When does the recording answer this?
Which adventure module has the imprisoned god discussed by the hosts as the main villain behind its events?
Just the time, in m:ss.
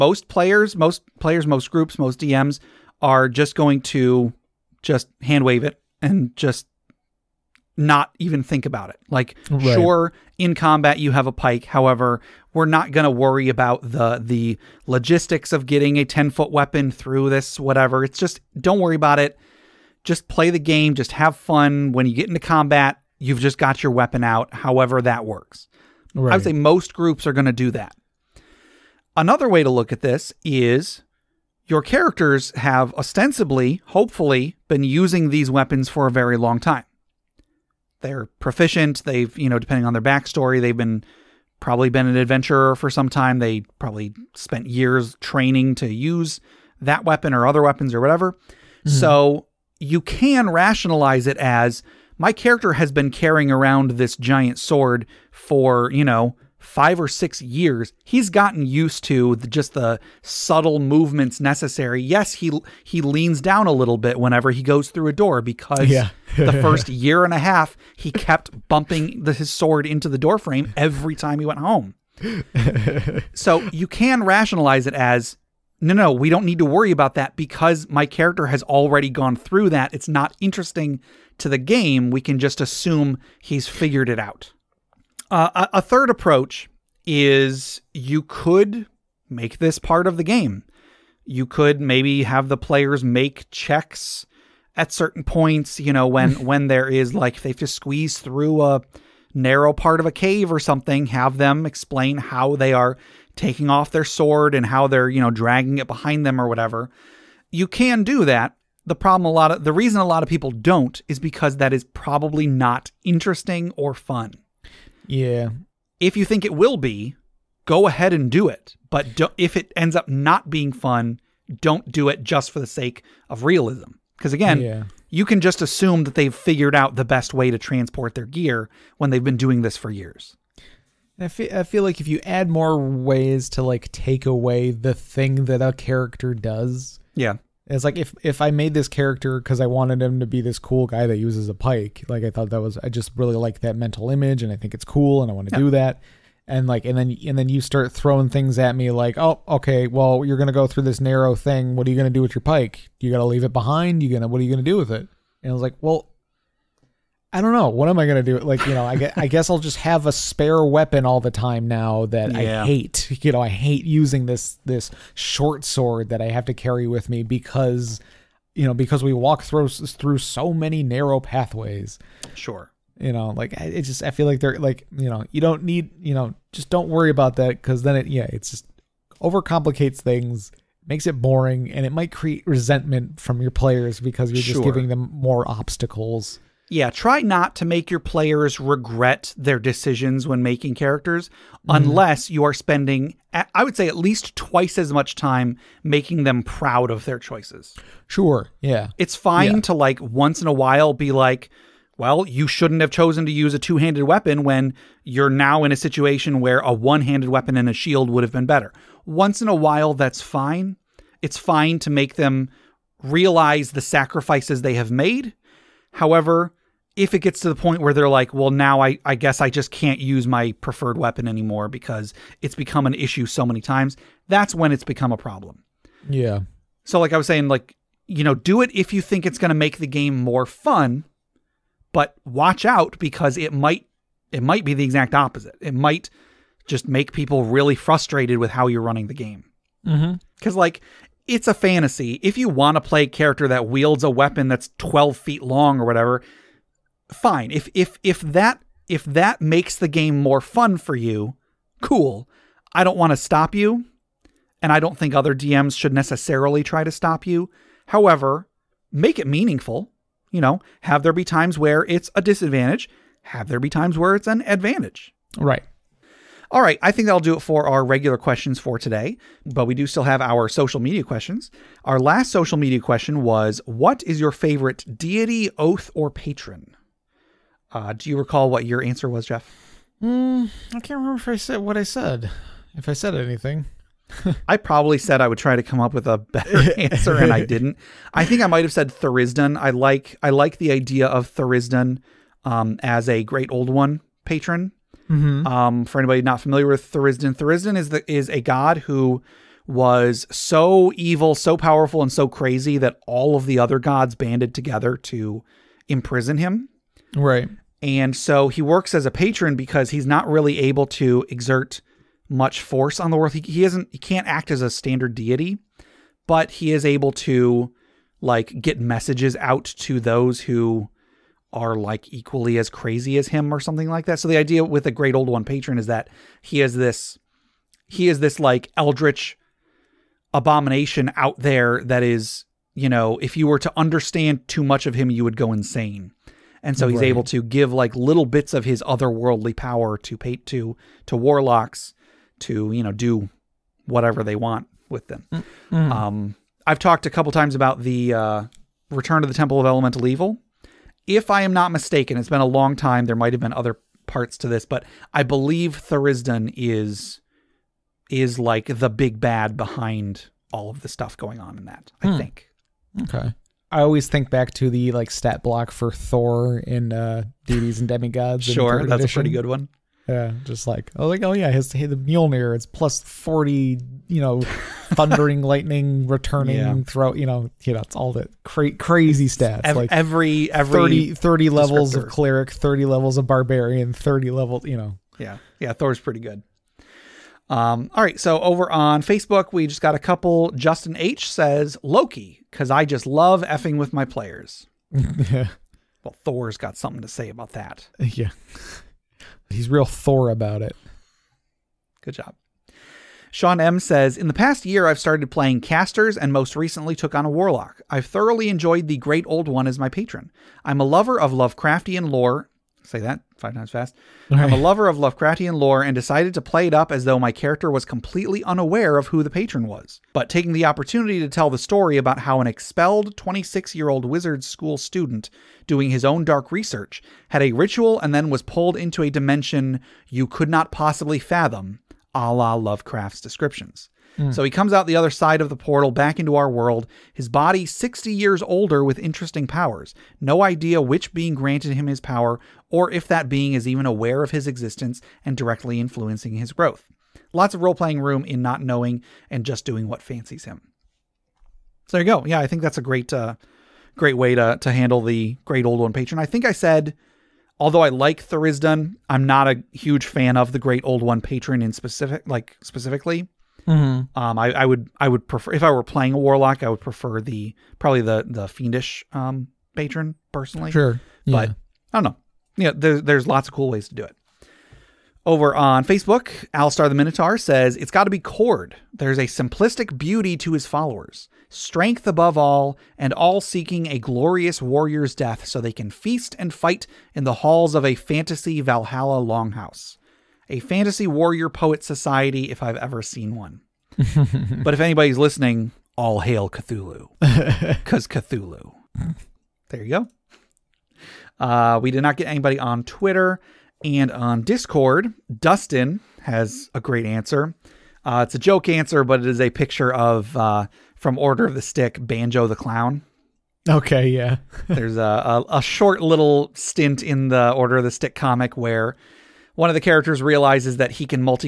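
5:48.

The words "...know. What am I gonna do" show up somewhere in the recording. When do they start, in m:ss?
2:37.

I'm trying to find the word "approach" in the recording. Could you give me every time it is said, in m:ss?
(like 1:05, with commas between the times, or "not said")
1:26.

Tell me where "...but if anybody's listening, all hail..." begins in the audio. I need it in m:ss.
8:14.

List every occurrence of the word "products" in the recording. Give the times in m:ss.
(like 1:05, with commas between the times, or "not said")
not said.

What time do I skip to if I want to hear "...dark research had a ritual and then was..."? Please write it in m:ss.
7:06.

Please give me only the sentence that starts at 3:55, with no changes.
It might just make people really frustrated with how you're running the game.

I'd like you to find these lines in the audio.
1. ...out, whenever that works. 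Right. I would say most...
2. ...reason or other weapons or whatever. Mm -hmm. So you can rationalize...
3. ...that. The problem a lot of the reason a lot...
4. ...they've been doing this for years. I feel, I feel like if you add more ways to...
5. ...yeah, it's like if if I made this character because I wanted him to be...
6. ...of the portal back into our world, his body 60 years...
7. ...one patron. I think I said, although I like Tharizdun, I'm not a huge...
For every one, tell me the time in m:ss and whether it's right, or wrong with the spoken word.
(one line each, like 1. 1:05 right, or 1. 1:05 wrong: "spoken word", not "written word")
1. 0:24 wrong: "however", not "whenever"
2. 0:47 wrong: "weapon", not "reason"
3. 1:48 right
4. 2:09 right
5. 2:17 right
6. 7:15 right
7. 7:35 right.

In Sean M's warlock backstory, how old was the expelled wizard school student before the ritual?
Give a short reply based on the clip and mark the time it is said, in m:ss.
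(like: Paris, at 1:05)
26, at 7:03.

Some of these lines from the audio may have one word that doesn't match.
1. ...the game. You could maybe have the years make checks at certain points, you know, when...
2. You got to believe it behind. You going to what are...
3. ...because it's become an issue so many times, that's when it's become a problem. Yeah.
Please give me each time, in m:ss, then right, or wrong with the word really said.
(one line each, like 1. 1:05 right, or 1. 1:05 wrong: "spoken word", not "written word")
1. 1:30 wrong: "players", not "years"
2. 2:33 wrong: "leave", not "believe"
3. 3:41 right.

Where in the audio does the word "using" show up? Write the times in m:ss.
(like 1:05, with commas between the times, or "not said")
0:34, 2:43.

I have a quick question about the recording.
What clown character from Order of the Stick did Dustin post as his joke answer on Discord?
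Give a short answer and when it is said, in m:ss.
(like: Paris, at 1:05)
Banjo the Clown, at 8:31.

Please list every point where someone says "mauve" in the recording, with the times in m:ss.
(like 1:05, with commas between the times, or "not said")
not said.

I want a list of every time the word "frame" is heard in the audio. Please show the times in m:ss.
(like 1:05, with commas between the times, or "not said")
1:10.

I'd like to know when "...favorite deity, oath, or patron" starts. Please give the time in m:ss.
4:34.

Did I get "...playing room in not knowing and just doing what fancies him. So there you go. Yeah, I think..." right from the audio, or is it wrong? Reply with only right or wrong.
right.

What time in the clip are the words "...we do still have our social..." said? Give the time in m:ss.
4:29.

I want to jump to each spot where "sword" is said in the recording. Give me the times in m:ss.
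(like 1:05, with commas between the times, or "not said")
0:54, 1:09, 1:44, 2:45.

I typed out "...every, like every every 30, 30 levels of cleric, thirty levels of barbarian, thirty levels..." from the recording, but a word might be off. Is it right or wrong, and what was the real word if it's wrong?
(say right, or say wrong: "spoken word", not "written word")
right.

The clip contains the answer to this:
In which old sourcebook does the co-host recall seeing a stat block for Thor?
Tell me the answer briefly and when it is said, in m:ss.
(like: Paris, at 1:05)
Deities and Demigods, at 6:07.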